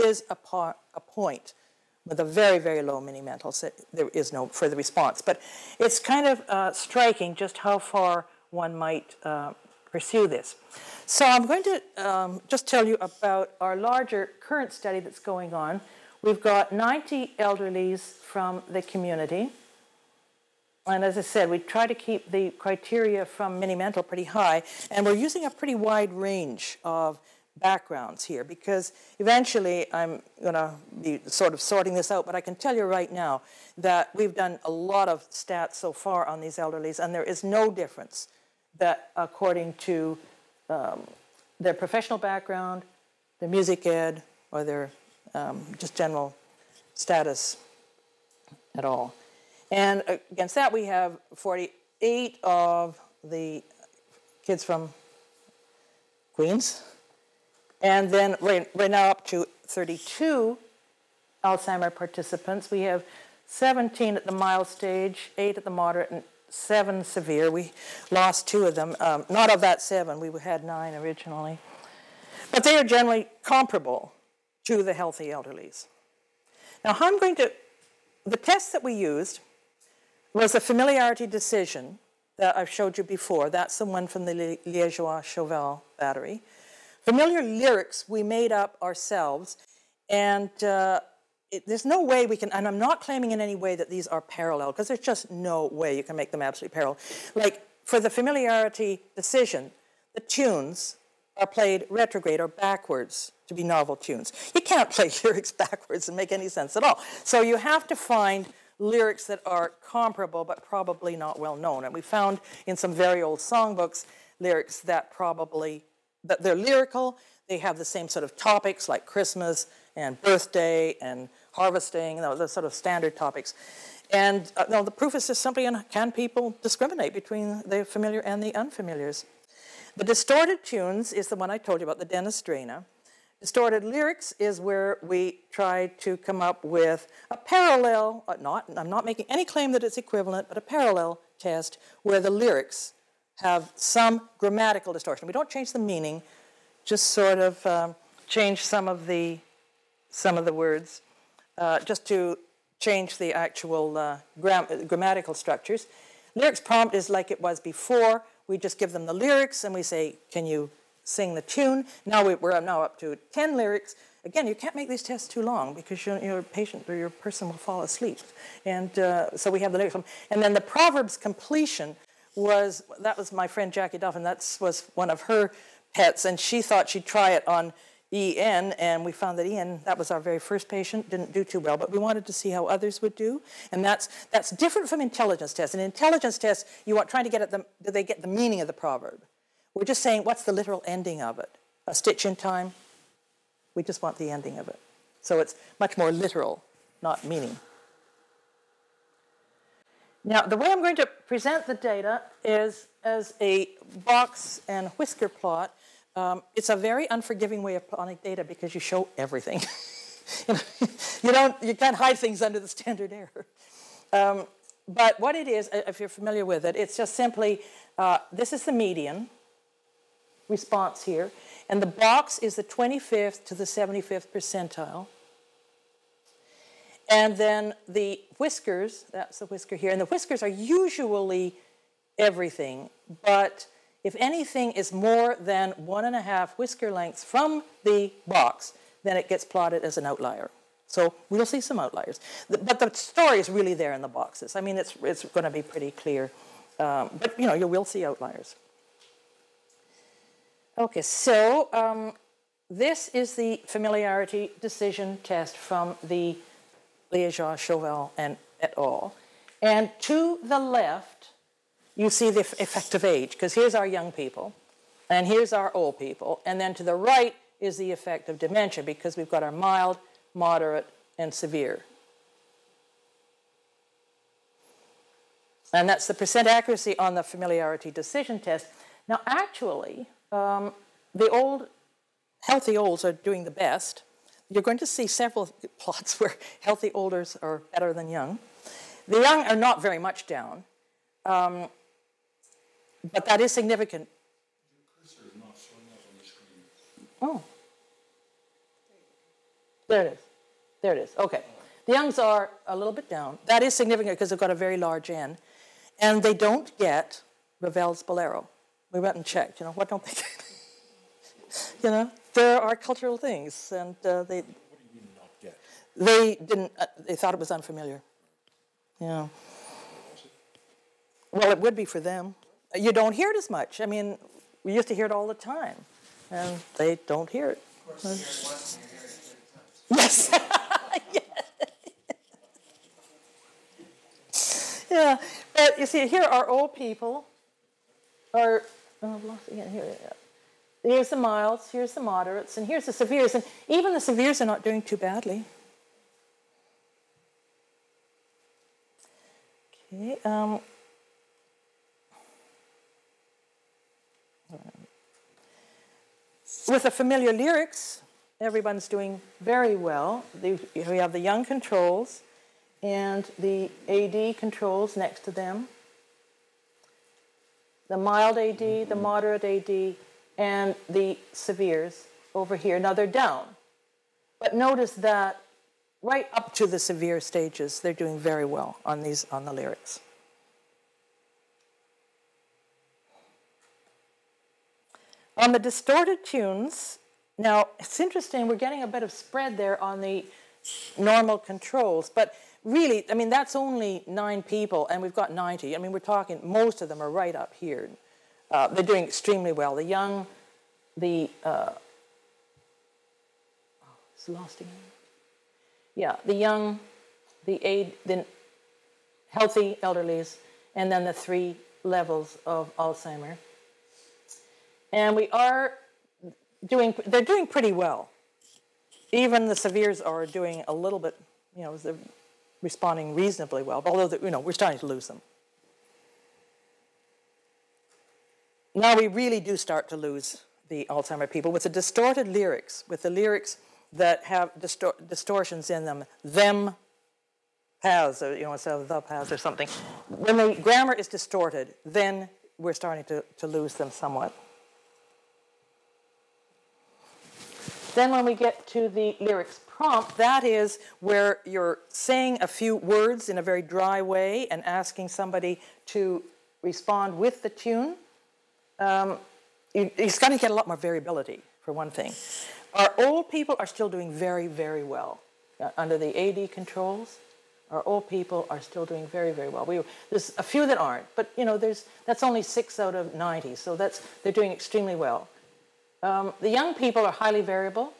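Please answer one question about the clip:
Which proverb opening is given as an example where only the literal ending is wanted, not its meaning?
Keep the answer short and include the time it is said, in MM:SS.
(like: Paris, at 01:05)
A stitch in time, at 03:11.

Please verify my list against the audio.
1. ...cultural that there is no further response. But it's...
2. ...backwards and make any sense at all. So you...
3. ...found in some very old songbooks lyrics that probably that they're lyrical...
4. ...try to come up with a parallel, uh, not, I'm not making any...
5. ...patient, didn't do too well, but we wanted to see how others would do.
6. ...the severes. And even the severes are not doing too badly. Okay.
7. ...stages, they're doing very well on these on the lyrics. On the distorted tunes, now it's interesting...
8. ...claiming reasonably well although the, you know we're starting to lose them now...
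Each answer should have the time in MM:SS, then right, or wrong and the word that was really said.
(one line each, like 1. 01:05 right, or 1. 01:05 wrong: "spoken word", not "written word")
1. 00:03 wrong: "mental", not "cultural"
2. 01:45 right
3. 01:52 right
4. 02:15 right
5. 03:00 right
6. 05:42 right
7. 06:17 right
8. 07:02 wrong: "responding", not "claiming".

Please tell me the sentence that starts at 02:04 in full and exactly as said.
And uh, no, the proof is just simply in can people discriminate between the familiar and the unfamiliars?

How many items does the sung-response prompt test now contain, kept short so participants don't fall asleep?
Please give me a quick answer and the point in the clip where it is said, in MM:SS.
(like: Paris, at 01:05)
10, at 02:43.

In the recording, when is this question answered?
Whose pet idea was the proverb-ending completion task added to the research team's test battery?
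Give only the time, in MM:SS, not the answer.
02:53.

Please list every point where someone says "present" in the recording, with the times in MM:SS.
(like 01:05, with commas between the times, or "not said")
03:21.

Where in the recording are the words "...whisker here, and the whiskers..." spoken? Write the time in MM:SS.
03:49.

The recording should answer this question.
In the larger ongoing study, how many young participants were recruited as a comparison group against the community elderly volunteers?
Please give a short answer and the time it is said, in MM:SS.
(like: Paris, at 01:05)
48, at 00:51.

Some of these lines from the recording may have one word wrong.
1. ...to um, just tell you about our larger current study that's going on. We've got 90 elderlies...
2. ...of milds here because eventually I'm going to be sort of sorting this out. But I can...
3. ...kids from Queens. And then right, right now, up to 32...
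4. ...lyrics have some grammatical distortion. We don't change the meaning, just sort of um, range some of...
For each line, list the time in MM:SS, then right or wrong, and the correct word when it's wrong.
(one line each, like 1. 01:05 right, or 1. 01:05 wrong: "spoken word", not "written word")
1. 00:11 right
2. 00:26 wrong: "backgrounds", not "milds"
3. 00:54 right
4. 02:22 wrong: "change", not "range".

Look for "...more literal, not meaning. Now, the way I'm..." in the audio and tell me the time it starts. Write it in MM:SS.
03:15.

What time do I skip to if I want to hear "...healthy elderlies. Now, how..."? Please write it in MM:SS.
01:14.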